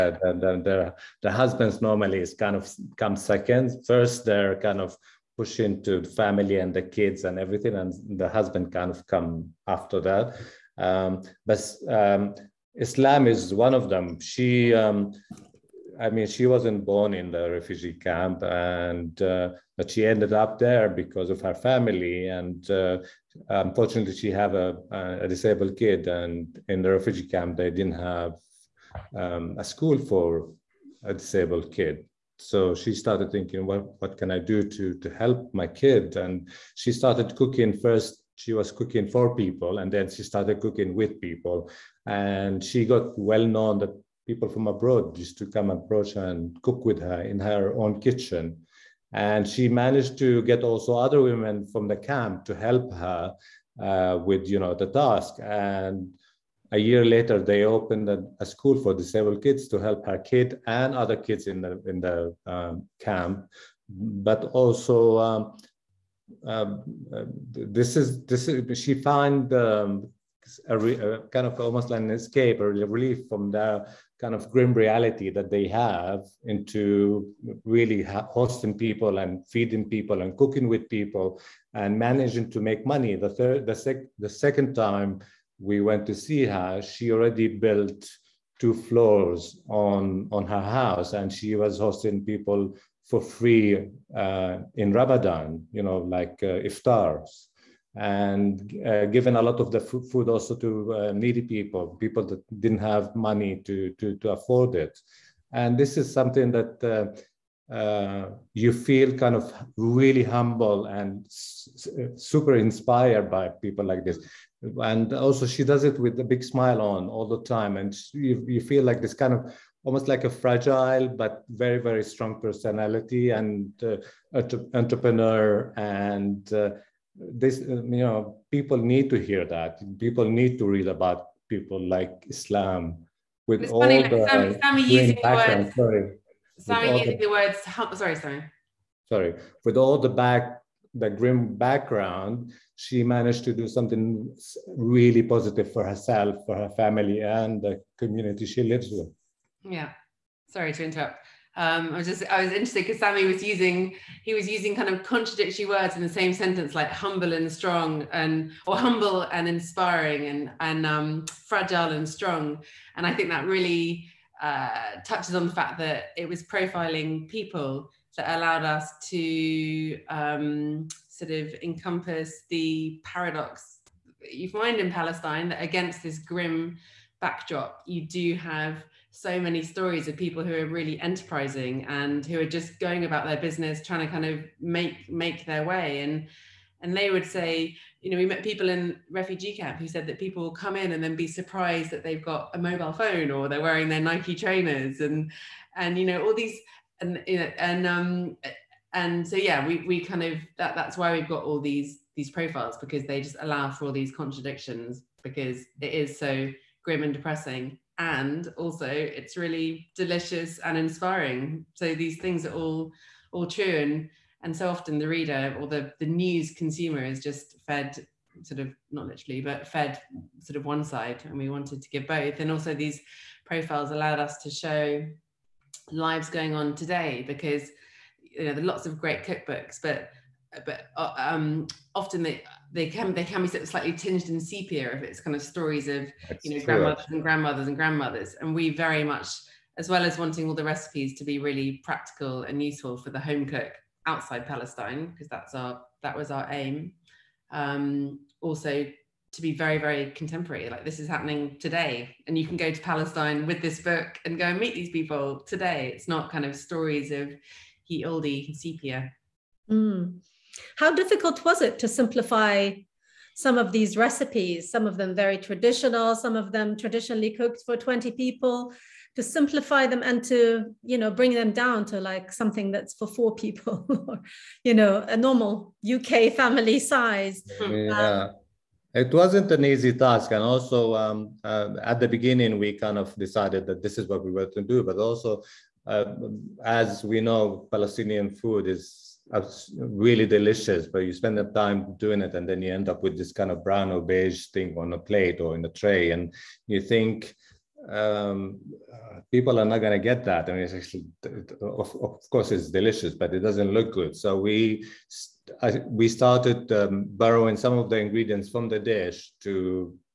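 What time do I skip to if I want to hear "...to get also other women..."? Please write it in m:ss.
0:50.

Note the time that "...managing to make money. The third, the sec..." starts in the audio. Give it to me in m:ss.
1:21.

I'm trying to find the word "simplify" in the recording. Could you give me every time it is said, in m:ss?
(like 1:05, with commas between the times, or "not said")
4:21, 4:29.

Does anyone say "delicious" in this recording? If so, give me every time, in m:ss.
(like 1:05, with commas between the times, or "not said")
3:29, 4:50, 5:02.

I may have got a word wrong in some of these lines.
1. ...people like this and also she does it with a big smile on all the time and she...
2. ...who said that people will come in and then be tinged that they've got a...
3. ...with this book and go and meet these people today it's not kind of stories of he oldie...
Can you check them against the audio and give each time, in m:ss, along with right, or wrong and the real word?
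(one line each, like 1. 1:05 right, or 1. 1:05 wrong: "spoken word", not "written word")
1. 1:53 right
2. 3:09 wrong: "surprised", not "tinged"
3. 4:13 right.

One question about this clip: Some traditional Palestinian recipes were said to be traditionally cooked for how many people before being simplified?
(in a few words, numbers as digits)
20 people.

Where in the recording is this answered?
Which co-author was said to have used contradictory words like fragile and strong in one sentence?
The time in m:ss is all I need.
2:32.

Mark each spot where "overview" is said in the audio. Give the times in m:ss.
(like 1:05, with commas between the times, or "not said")
not said.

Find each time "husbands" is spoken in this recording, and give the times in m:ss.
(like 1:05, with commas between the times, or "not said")
0:01, 0:08.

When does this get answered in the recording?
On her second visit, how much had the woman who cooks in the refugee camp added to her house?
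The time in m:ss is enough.
1:28.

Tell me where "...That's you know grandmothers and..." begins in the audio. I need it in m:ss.
3:56.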